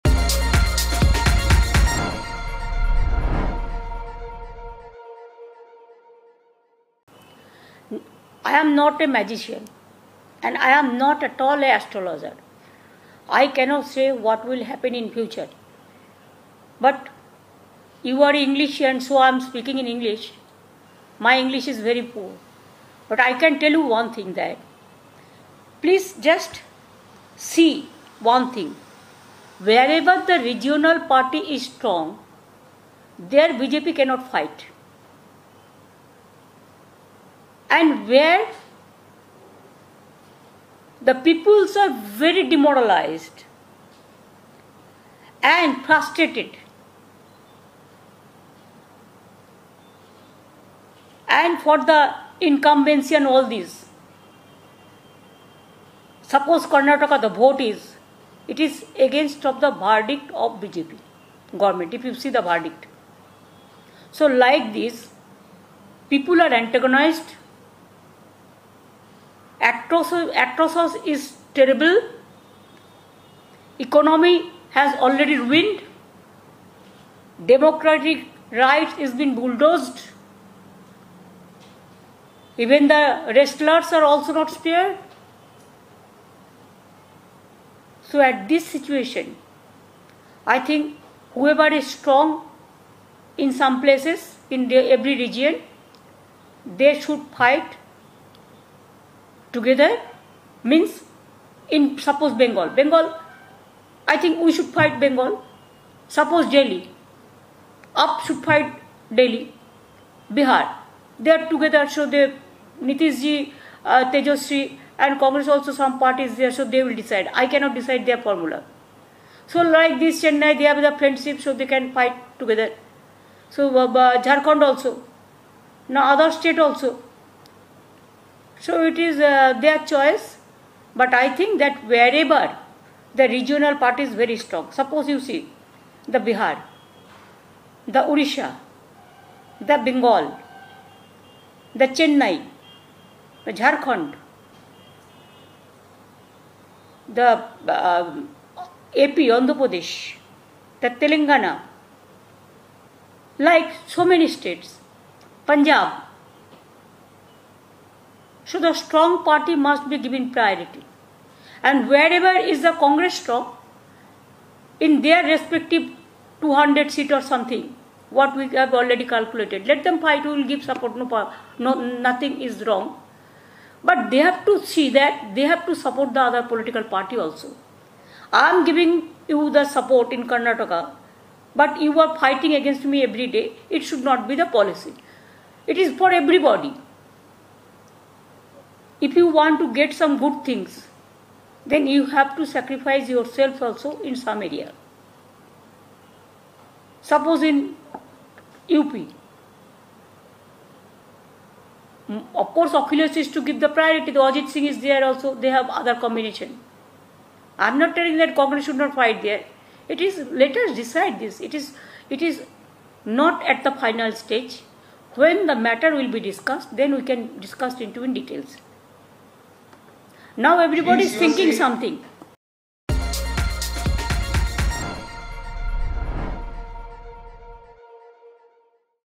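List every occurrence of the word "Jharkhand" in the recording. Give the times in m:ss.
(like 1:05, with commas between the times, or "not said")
2:04, 2:23.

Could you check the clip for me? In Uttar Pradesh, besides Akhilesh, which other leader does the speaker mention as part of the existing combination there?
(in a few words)
Ajit Singh.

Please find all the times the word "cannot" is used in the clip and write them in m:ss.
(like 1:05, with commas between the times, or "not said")
0:13, 0:33, 1:57.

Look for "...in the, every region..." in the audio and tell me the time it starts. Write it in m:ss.
1:34.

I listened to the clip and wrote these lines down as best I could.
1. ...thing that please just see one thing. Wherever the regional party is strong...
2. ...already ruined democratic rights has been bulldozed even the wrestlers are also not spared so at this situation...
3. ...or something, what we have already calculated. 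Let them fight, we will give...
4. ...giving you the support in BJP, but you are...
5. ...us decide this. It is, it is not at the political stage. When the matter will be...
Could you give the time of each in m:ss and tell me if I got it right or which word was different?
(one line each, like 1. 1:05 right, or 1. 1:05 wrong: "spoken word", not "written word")
1. 0:24 right
2. 1:15 right
3. 2:47 right
4. 2:58 wrong: "Karnataka", not "BJP"
5. 3:30 wrong: "final", not "political".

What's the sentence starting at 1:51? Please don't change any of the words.
They are together, so they, Nitishji, uh, Tejashwi and Congress also some parties there, so they will decide.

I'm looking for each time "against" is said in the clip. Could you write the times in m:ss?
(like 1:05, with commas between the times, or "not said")
0:59, 3:02.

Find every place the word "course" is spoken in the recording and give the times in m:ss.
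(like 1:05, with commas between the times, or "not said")
3:22.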